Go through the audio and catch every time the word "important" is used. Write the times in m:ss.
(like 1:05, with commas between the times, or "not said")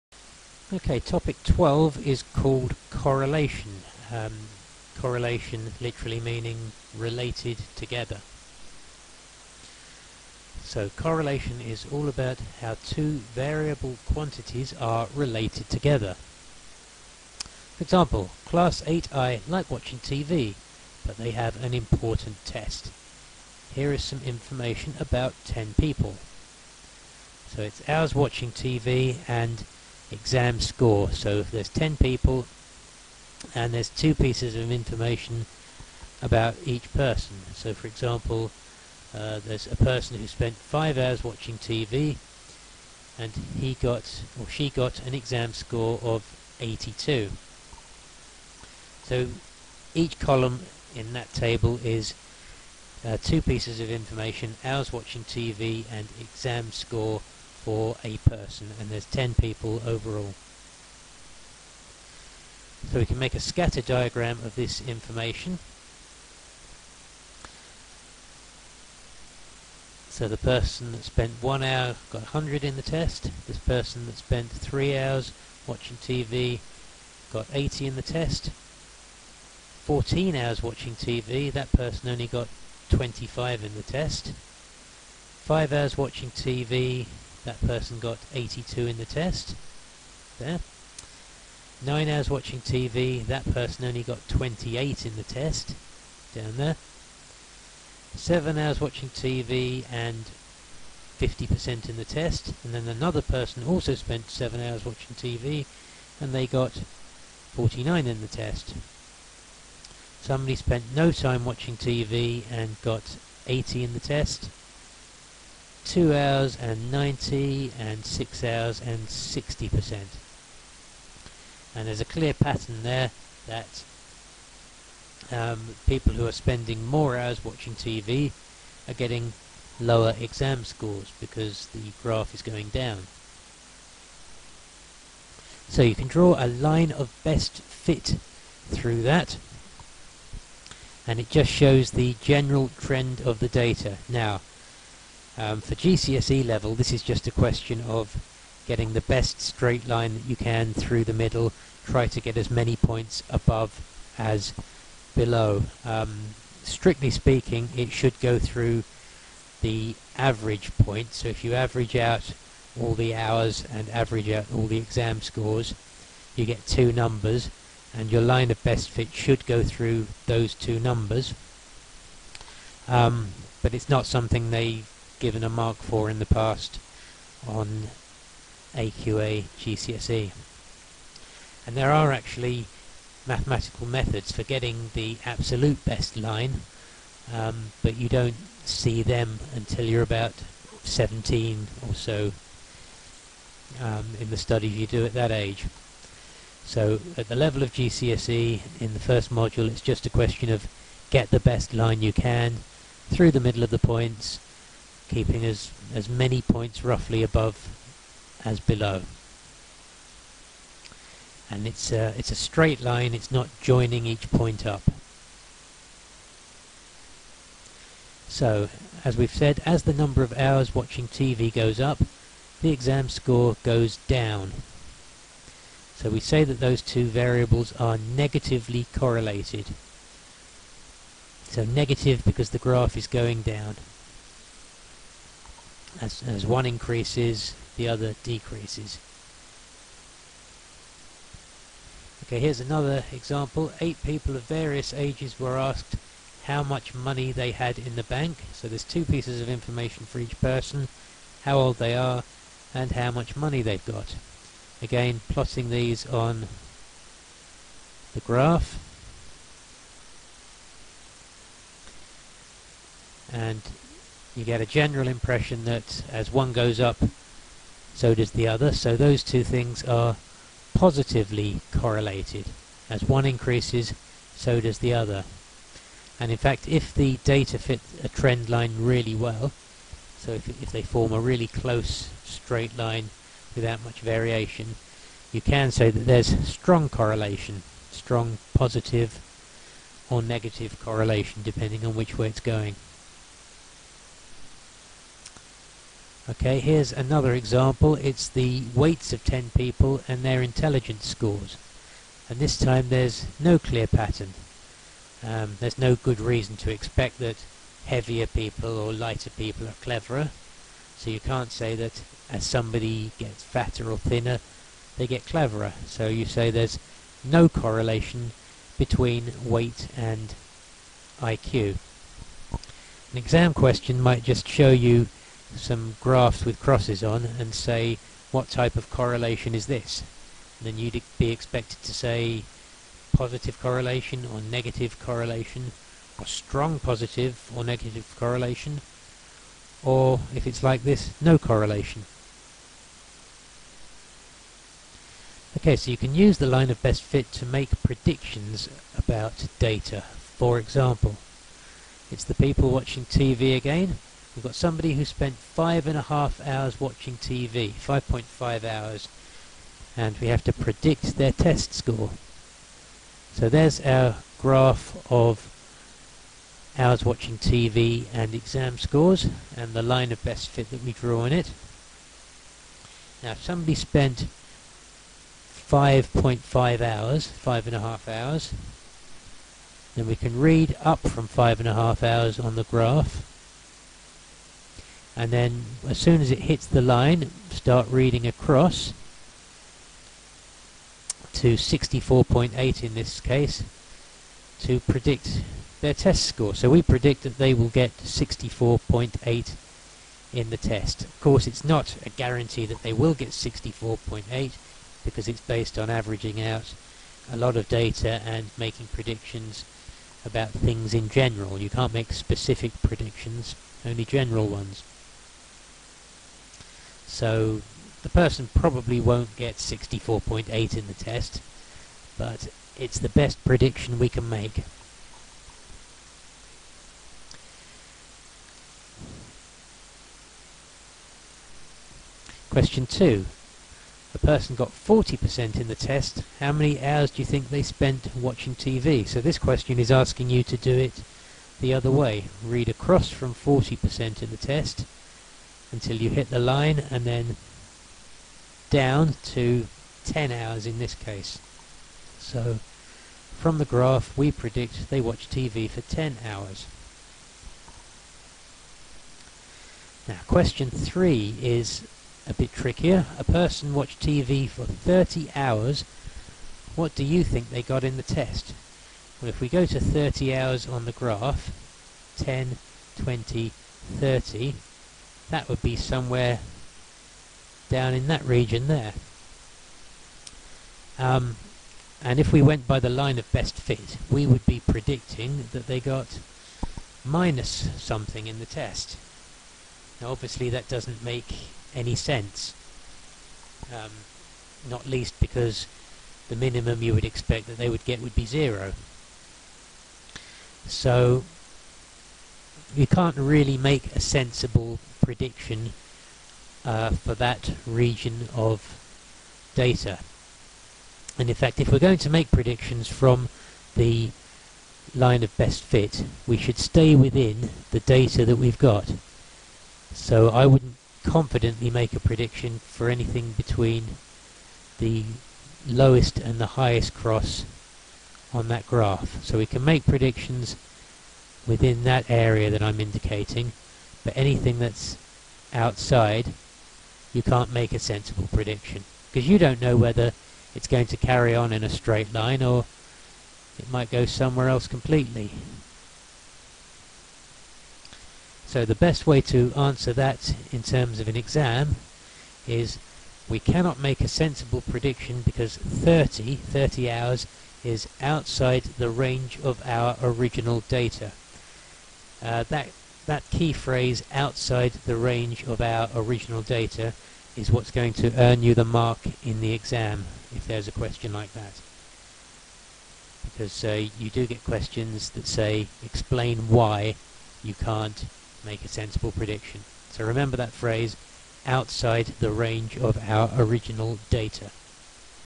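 0:21.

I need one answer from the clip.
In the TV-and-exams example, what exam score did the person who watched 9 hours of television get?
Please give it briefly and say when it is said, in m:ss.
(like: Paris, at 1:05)
28, at 1:34.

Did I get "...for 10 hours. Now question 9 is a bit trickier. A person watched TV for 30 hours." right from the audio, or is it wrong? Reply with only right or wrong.
wrong.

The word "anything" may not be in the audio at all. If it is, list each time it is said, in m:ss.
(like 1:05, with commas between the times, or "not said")
8:42, 8:54.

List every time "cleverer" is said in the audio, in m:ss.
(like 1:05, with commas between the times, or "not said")
5:09, 5:15.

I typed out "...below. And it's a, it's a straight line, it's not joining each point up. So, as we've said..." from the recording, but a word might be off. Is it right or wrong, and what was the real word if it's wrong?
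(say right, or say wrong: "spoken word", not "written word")
right.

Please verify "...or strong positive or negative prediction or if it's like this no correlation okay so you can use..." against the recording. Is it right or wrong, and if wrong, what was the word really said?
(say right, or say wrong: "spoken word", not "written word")
wrong: "correlation", not "prediction".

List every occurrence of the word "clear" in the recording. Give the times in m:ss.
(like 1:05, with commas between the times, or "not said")
2:02, 5:03.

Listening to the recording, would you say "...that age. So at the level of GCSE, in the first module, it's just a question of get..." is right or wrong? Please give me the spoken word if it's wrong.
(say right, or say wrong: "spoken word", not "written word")
right.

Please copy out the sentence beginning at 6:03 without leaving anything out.
So there's our graph of hours watching TV and exam scores and the line of best fit that we draw in it.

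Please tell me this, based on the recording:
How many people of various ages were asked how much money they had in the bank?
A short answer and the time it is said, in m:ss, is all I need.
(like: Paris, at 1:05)
8, at 4:03.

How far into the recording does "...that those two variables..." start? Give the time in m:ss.
3:46.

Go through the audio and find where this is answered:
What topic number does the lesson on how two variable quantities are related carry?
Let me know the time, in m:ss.
0:01.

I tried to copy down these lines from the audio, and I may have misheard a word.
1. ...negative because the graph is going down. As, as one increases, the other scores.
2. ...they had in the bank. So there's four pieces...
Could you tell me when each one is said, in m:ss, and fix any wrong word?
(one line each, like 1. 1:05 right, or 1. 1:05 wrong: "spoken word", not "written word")
1. 3:51 wrong: "decreases", not "scores"
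2. 4:07 wrong: "two", not "four".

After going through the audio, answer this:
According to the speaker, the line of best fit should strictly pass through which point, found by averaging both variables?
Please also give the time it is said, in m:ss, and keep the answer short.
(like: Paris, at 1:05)
The average point, at 2:39.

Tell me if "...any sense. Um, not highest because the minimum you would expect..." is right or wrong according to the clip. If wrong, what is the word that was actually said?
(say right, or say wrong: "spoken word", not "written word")
wrong: "least", not "highest".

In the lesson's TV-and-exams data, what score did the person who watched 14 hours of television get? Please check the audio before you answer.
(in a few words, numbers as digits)
25.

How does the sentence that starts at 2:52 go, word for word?
Um, but it's not something they given a mark for in the past on AQA GCSE.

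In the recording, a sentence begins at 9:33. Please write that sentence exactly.
Because uh, you do get questions that say explain why you can't make a sensible prediction.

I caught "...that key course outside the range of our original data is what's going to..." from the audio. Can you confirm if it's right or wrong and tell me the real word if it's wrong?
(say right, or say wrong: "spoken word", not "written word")
wrong: "phrase", not "course".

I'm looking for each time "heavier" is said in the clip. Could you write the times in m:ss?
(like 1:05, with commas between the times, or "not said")
5:07.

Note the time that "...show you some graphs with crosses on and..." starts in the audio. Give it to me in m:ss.
5:24.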